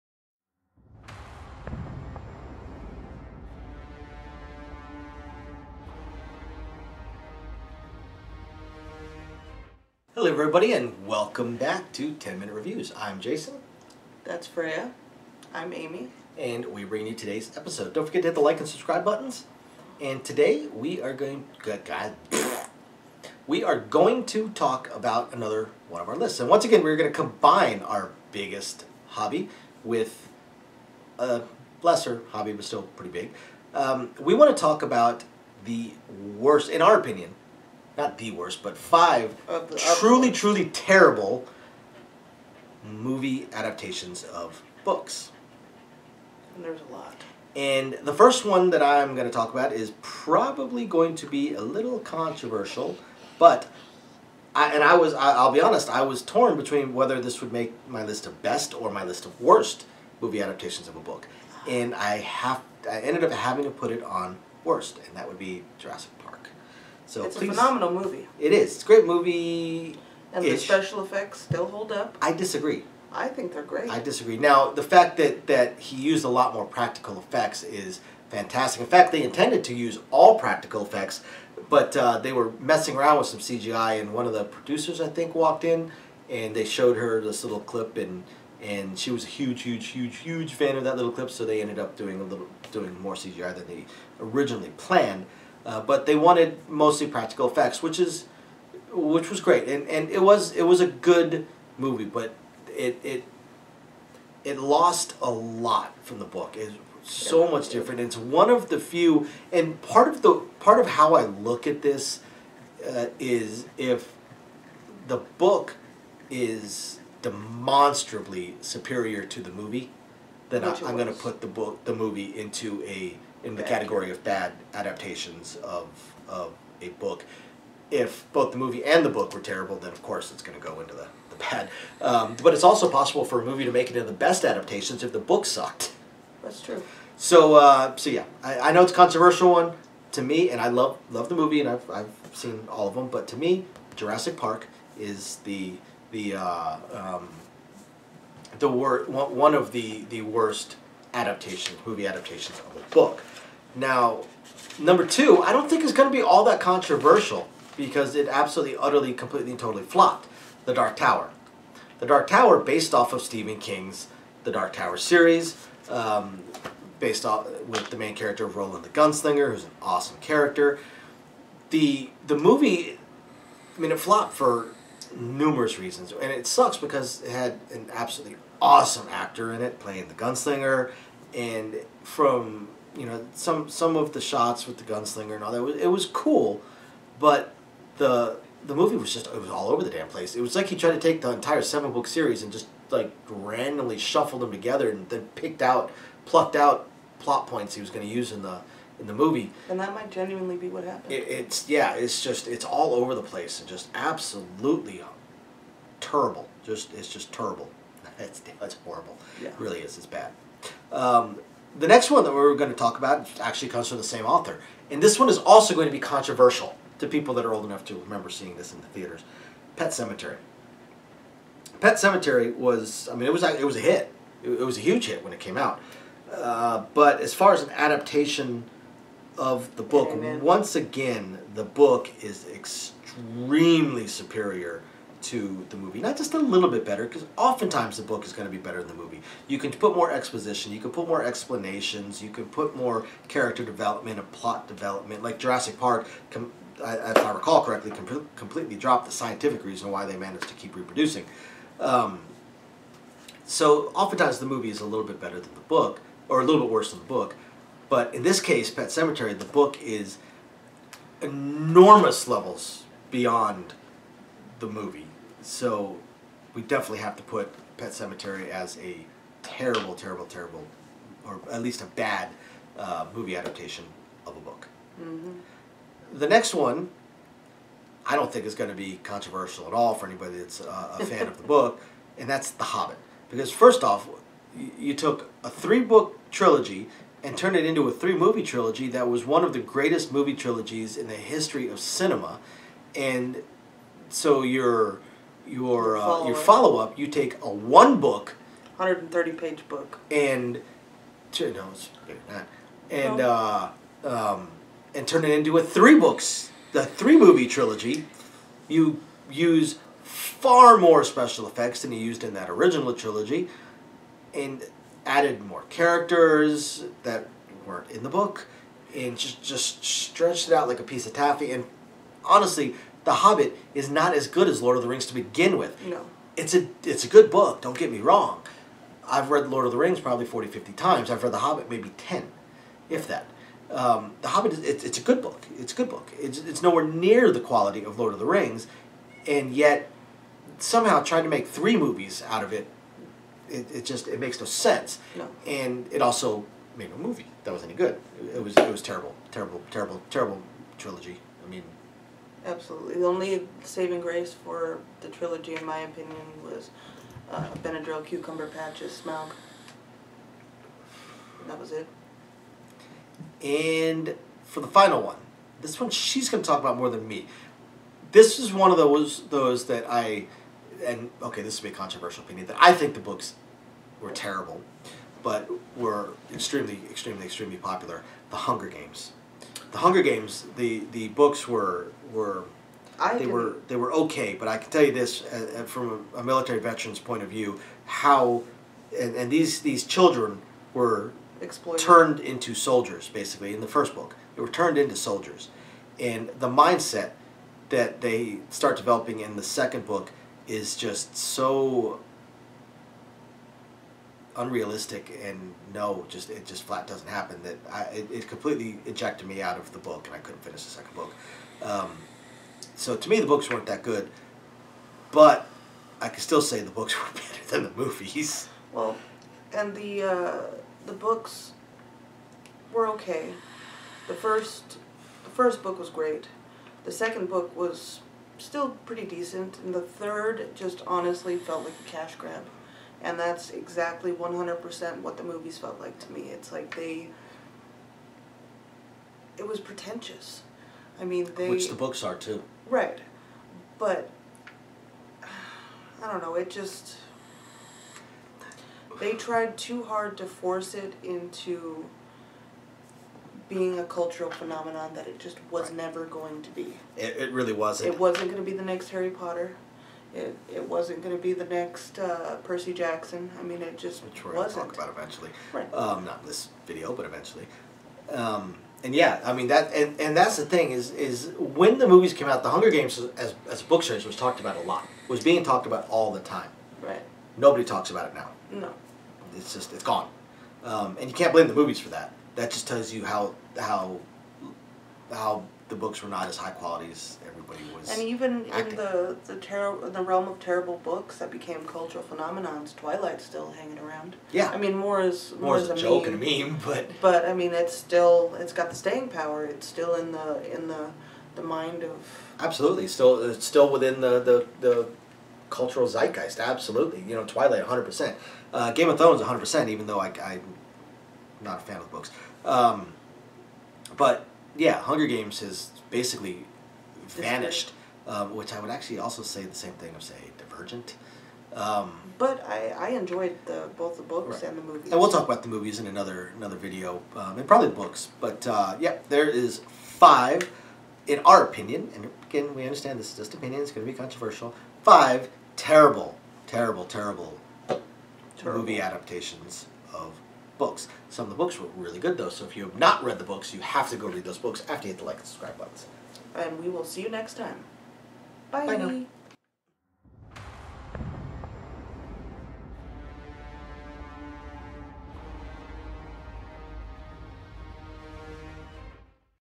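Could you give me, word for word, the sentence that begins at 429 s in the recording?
And the third just honestly felt like a cash grab.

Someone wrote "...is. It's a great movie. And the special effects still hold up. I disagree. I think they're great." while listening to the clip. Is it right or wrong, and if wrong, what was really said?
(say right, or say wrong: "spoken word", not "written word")
right.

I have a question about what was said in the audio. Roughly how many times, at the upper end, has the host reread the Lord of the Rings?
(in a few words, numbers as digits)
50.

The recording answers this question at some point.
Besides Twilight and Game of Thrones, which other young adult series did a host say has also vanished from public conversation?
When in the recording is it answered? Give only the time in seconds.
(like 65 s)
520 s.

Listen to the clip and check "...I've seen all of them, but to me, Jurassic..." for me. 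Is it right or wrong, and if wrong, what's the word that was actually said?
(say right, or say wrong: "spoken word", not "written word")
right.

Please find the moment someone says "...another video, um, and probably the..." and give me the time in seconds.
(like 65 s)
526 s.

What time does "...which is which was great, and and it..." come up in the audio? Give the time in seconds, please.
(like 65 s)
97 s.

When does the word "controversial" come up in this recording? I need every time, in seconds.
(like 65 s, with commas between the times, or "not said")
51 s, 138 s, 156 s, 215 s, 279 s, 371 s, 533 s.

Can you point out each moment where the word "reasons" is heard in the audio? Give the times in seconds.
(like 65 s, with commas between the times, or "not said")
175 s, 249 s.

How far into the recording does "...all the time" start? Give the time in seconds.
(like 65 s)
475 s.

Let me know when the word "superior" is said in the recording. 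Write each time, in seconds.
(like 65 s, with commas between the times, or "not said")
118 s, 234 s.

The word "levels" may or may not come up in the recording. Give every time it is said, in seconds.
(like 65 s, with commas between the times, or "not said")
262 s.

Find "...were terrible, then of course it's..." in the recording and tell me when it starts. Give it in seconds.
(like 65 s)
129 s.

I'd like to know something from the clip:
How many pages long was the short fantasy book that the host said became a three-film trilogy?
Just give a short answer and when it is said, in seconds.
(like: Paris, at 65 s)
130, at 298 s.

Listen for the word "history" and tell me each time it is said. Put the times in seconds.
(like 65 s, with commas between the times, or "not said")
291 s.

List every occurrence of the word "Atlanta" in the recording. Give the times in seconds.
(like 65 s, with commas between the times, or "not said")
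not said.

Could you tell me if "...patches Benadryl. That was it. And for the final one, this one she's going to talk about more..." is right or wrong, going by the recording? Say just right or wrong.
wrong.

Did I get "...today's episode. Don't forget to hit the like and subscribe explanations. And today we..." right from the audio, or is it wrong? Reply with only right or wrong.
wrong.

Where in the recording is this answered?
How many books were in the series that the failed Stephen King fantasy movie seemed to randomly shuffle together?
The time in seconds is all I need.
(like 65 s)
191 s.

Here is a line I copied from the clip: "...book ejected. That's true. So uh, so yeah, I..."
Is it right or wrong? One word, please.
wrong.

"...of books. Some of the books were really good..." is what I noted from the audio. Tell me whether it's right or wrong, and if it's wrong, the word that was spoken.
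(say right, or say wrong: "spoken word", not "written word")
right.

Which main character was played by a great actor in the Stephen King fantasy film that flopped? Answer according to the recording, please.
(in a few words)
Roland the Gunslinger.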